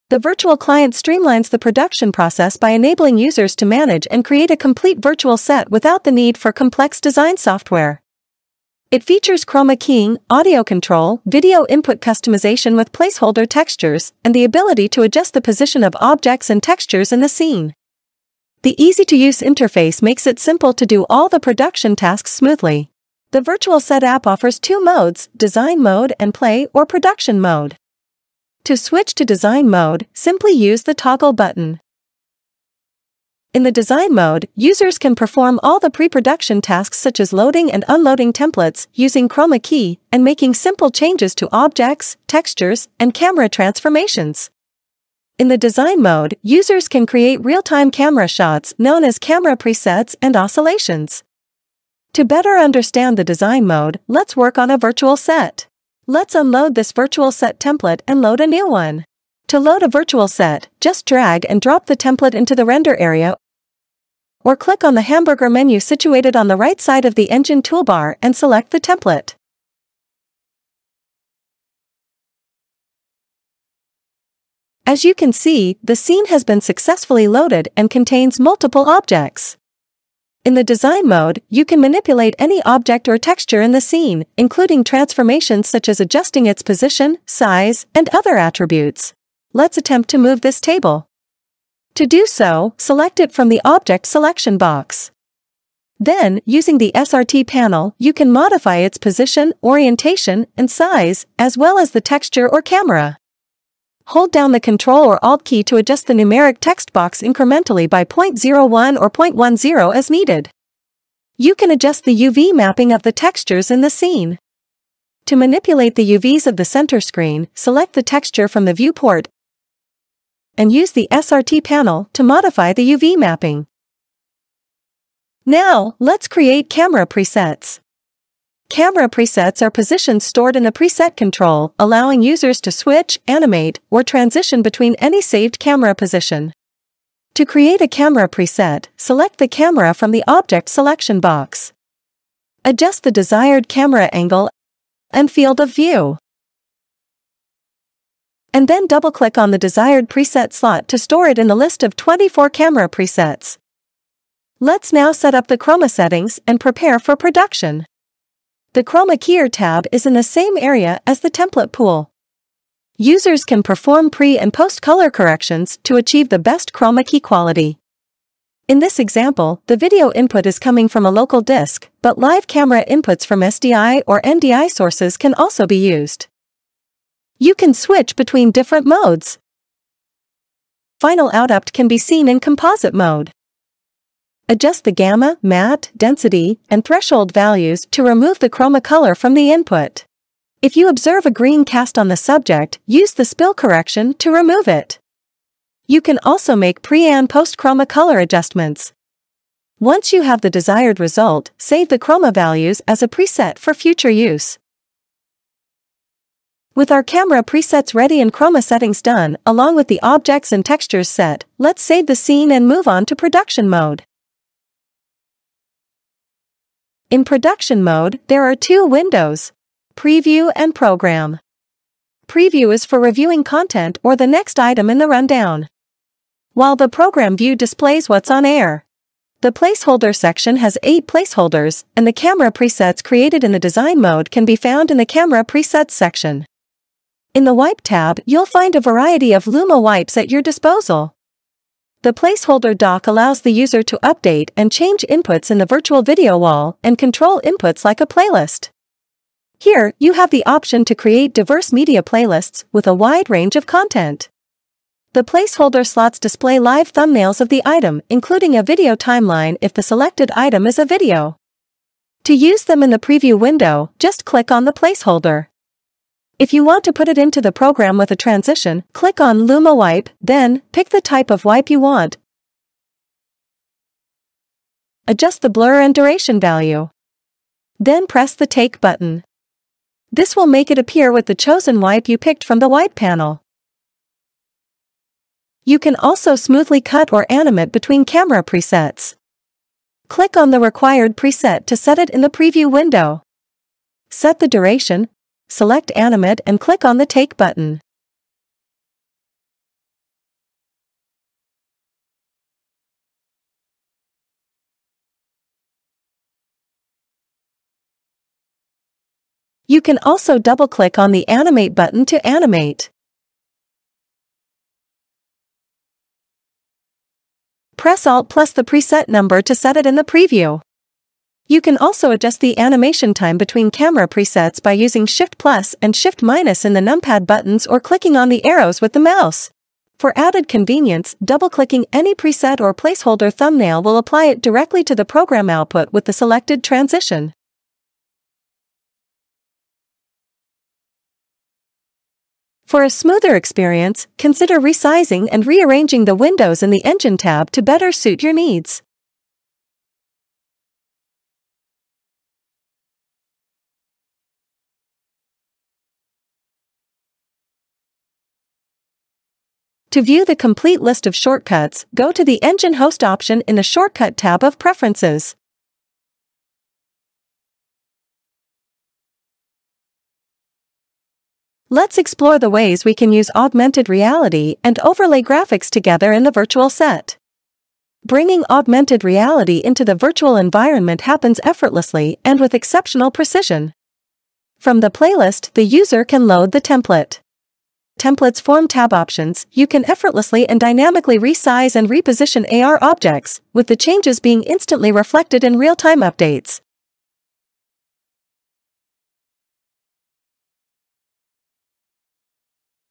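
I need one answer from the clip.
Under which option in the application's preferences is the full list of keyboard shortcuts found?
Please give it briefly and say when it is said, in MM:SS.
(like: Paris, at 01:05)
Engine Host, at 06:02.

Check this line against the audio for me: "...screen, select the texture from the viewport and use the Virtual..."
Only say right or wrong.
wrong.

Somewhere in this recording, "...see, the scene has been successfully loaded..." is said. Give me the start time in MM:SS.
01:15.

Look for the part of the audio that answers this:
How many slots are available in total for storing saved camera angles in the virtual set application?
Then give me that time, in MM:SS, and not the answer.
02:31.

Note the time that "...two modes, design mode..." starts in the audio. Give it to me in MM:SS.
00:24.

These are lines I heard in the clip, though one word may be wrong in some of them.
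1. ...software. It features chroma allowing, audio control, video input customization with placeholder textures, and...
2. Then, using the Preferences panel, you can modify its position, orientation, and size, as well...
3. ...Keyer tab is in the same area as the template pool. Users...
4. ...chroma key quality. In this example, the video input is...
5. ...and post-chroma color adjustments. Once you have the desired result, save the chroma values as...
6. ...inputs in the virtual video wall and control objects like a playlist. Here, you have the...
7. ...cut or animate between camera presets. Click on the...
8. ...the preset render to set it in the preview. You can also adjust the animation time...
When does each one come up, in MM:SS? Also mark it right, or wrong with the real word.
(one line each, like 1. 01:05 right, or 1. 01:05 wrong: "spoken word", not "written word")
1. 00:07 wrong: "keying", not "allowing"
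2. 01:35 wrong: "SRT", not "Preferences"
3. 02:39 right
4. 02:46 right
5. 03:17 right
6. 04:05 wrong: "inputs", not "objects"
7. 04:46 right
8. 05:18 wrong: "number", not "render".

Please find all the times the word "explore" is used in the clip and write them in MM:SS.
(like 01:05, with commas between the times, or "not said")
06:11.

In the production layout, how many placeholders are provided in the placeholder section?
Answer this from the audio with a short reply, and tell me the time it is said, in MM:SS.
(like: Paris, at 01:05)
8, at 03:50.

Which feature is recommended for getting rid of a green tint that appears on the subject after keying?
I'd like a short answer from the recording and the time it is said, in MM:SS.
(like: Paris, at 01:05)
spill correction, at 03:13.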